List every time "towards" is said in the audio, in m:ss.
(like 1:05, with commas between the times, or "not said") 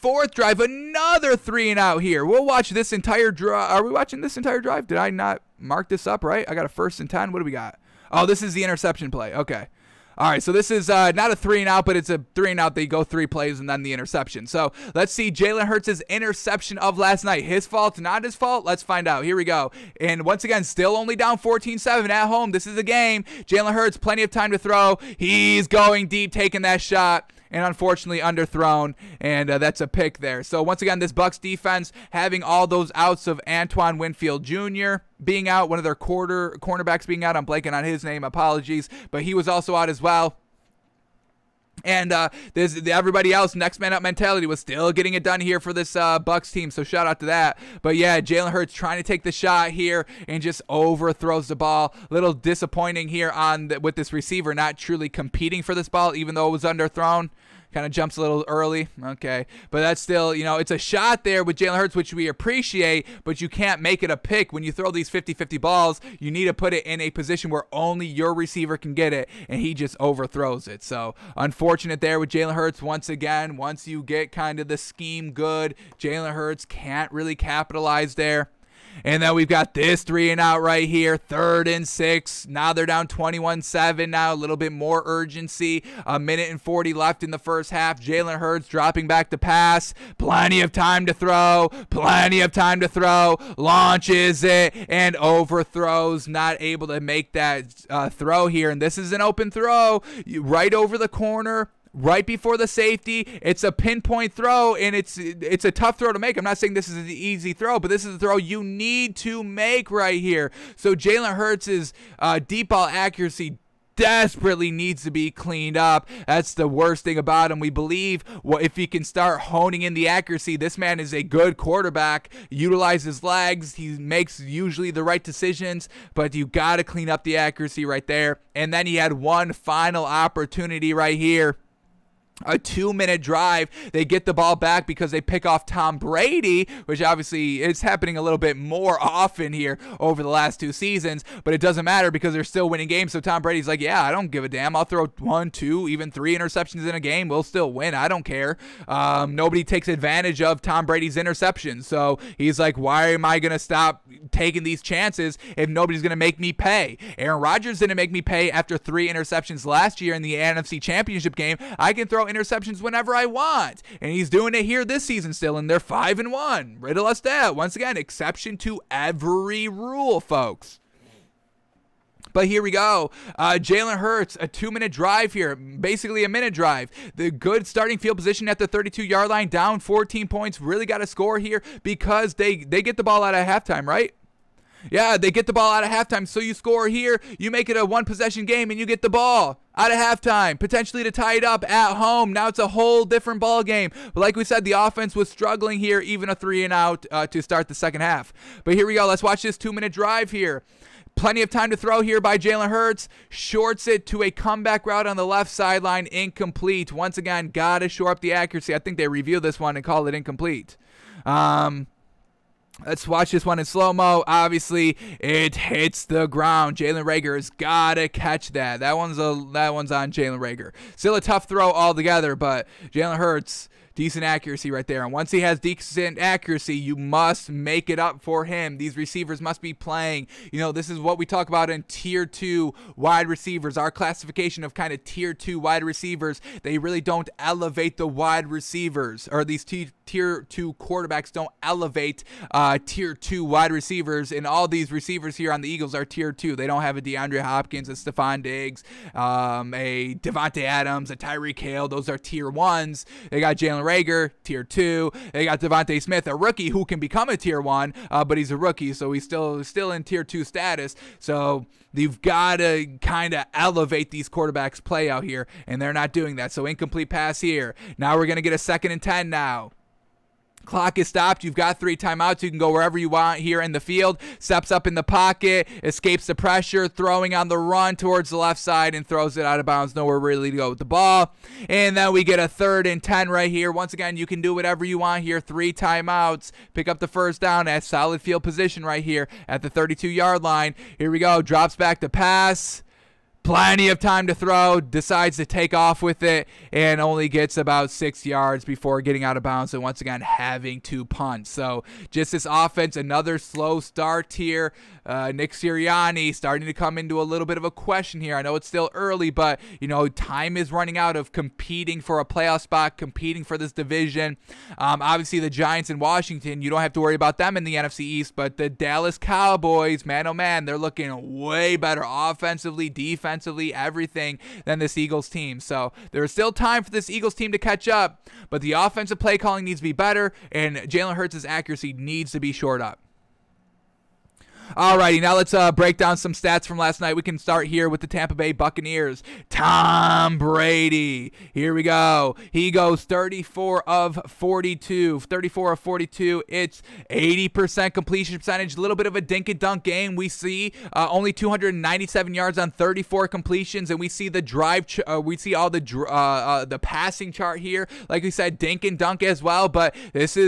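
4:37.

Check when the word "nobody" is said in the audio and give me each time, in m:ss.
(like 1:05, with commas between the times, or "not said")
2:29, 2:35.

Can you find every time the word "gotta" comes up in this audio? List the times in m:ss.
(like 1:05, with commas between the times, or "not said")
3:27, 3:37.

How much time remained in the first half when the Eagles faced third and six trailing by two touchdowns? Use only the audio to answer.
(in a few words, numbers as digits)
A minute and 40.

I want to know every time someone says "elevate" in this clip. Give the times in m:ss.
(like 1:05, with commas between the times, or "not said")
3:57, 4:01, 4:23.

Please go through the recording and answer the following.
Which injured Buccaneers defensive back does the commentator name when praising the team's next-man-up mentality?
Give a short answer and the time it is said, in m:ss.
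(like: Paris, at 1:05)
Antoine Winfield Jr., at 0:33.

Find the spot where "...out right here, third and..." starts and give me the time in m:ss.
1:20.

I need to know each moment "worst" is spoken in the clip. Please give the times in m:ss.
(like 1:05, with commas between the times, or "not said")
1:56.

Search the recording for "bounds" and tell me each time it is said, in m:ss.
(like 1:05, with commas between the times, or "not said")
4:39, 4:59.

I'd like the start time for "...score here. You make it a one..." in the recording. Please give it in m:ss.
3:06.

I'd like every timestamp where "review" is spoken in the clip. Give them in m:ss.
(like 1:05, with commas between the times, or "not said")
3:29.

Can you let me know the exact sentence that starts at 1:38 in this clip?
And this is an open throw right over the corner right before the safety.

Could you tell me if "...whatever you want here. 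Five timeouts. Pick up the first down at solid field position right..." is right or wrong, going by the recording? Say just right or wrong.
wrong.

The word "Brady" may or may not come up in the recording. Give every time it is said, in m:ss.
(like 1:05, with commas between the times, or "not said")
2:15, 2:23, 2:30, 5:40.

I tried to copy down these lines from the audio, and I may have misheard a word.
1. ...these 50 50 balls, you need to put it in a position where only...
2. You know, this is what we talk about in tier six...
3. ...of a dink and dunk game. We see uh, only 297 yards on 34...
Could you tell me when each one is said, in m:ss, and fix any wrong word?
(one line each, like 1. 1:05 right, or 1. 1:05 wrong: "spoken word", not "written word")
1. 1:04 right
2. 3:50 wrong: "two", not "six"
3. 5:49 right.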